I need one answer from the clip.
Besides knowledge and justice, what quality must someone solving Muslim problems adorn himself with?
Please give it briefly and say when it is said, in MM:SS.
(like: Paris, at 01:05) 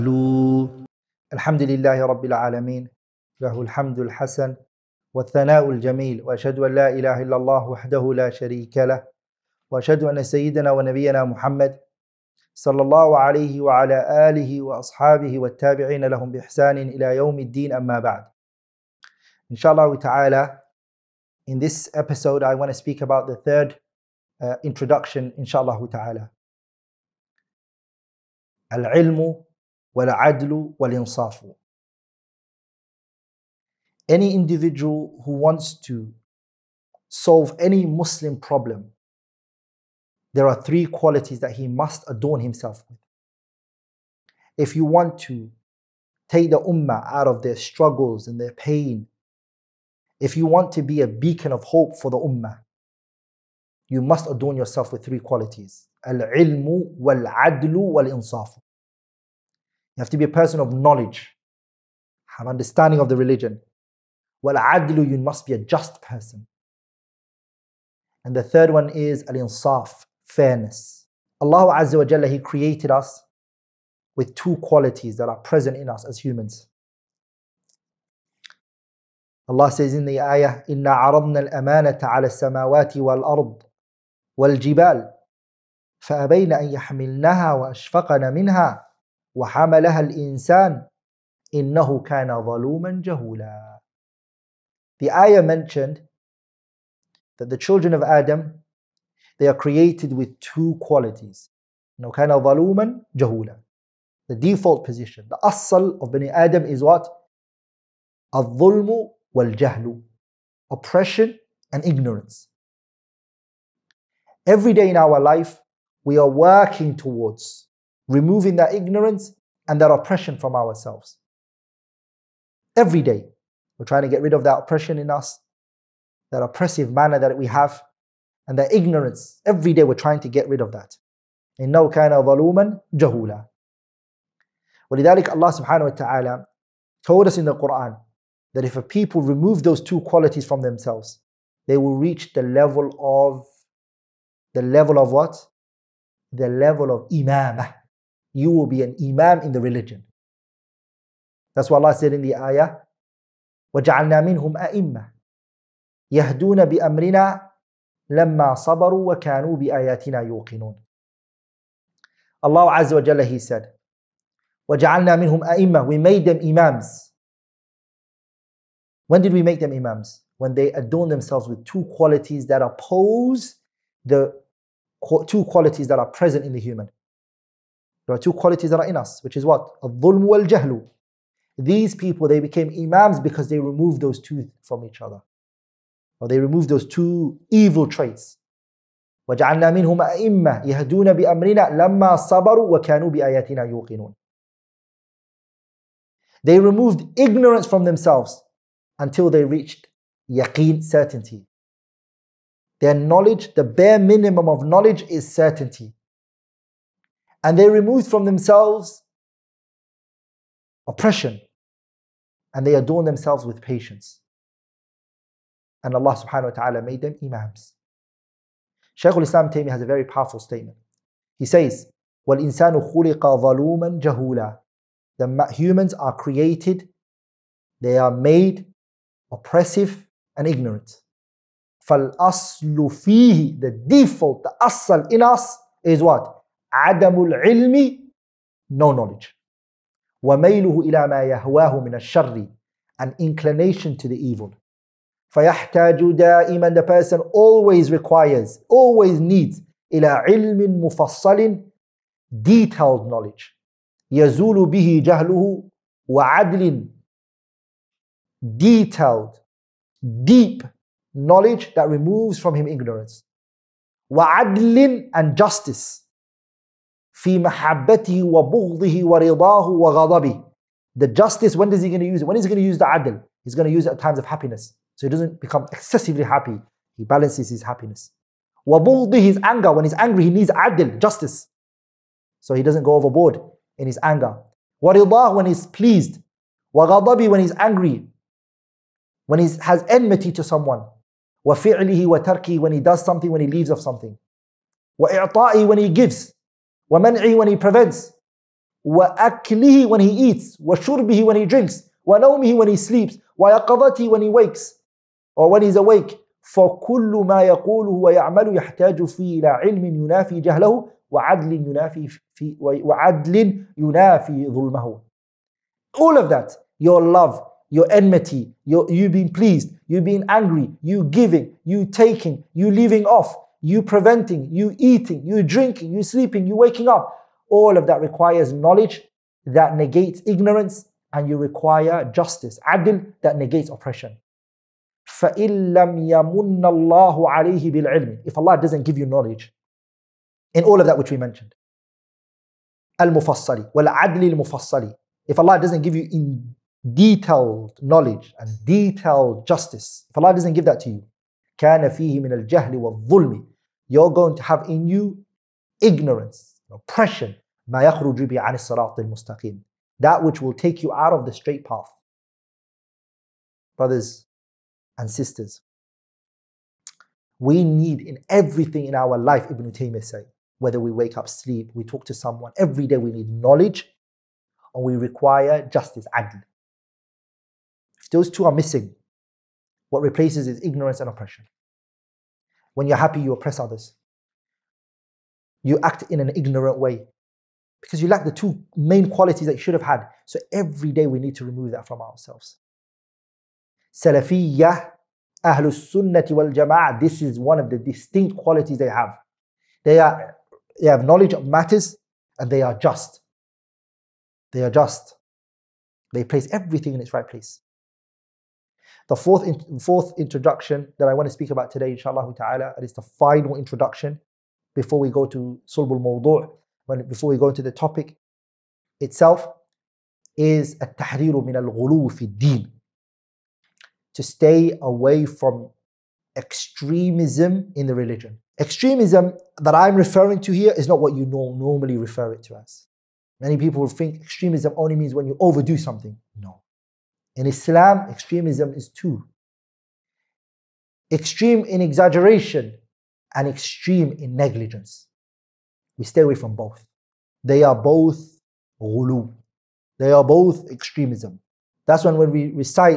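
fairness, at 01:10.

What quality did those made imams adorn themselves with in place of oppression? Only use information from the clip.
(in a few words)
patience.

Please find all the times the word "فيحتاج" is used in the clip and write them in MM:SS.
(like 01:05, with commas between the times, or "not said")
04:05.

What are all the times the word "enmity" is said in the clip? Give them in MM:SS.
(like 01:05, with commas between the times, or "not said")
04:49, 05:17.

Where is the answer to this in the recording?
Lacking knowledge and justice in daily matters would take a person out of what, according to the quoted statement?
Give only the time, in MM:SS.
06:01.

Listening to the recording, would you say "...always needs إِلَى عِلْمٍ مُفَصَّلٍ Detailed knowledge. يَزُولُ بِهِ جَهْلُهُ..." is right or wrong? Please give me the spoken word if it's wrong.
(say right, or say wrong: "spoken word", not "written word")
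right.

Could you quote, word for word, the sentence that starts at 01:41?
You know, كَانَ The default position, the asal of Bani Adam is what?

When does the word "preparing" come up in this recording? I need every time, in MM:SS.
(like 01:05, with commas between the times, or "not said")
not said.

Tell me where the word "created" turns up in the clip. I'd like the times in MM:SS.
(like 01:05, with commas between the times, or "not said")
01:12, 01:39, 03:46.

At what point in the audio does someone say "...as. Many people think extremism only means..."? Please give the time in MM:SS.
07:12.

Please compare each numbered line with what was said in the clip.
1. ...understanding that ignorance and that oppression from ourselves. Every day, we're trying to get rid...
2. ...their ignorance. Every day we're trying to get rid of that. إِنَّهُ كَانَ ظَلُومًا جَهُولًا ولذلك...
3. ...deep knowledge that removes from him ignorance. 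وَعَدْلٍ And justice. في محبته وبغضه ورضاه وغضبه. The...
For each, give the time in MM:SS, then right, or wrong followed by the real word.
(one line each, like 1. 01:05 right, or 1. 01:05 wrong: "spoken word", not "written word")
1. 01:58 wrong: "removing", not "understanding"
2. 02:08 right
3. 04:20 right.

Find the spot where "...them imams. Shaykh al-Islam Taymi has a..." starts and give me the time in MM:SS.
03:37.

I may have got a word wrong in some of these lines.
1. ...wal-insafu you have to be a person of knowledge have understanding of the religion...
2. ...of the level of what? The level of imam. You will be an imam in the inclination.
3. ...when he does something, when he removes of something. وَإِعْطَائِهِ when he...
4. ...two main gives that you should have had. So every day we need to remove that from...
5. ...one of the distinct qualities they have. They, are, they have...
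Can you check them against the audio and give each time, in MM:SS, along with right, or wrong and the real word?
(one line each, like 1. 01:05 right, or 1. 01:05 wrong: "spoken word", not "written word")
1. 00:57 right
2. 02:22 wrong: "religion", not "inclination"
3. 04:52 wrong: "leaves", not "removes"
4. 06:28 wrong: "qualities", not "gives"
5. 06:37 right.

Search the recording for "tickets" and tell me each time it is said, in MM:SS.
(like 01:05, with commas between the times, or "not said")
not said.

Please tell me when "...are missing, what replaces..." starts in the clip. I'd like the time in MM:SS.
06:18.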